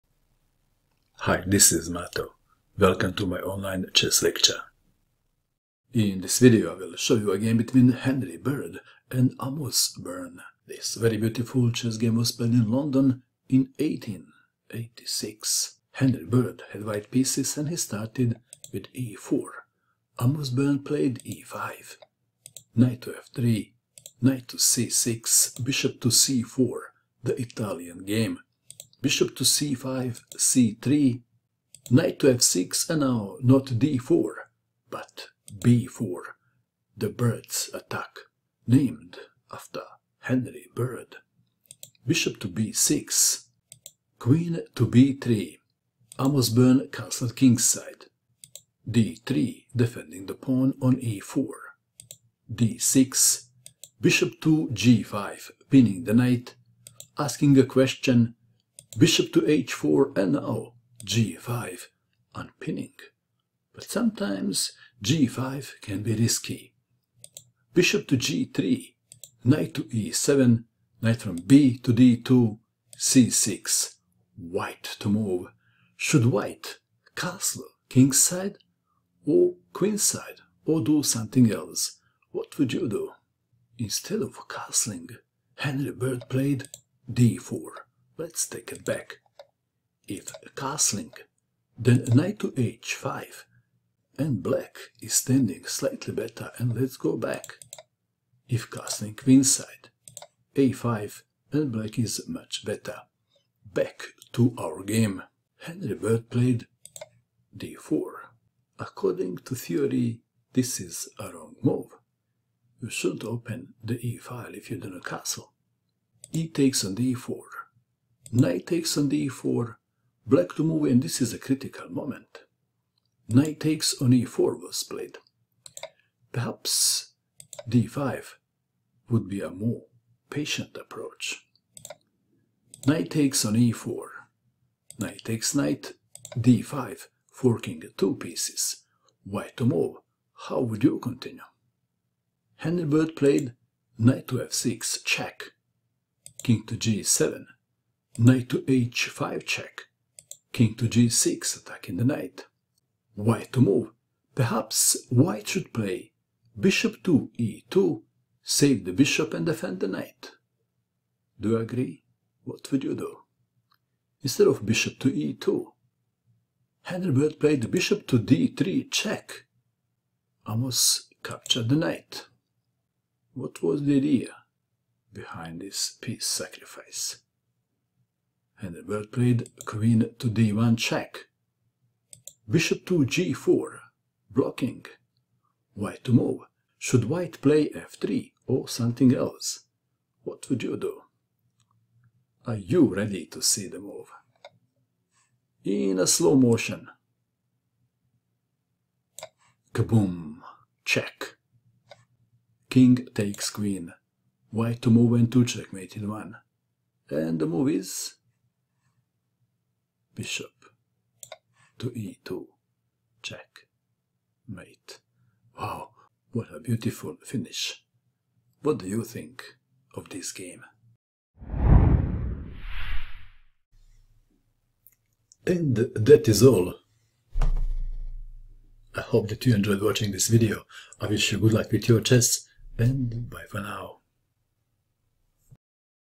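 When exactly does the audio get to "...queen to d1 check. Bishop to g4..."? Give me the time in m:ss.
2:59.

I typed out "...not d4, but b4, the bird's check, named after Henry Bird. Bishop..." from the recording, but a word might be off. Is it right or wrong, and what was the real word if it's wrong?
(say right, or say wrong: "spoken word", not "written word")
wrong: "attack", not "check".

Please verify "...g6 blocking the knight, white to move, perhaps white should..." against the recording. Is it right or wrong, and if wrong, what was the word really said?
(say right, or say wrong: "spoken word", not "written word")
wrong: "attacking", not "blocking".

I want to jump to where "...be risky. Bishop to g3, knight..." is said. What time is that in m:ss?
1:06.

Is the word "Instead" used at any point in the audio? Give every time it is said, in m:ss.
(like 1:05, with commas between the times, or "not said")
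1:23, 2:44.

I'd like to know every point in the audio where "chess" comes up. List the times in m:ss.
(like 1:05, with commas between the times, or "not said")
0:03, 0:11, 3:52.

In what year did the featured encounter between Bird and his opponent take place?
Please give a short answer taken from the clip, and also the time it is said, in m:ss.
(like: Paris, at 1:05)
1886, at 0:13.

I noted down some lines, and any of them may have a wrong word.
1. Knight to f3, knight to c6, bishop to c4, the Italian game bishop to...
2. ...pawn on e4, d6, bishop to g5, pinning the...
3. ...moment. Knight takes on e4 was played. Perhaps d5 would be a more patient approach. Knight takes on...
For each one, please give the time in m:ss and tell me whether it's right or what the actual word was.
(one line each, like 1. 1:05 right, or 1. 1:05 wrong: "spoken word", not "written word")
1. 0:22 right
2. 0:50 right
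3. 2:01 right.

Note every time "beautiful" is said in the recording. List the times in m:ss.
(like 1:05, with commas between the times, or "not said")
0:11, 3:36.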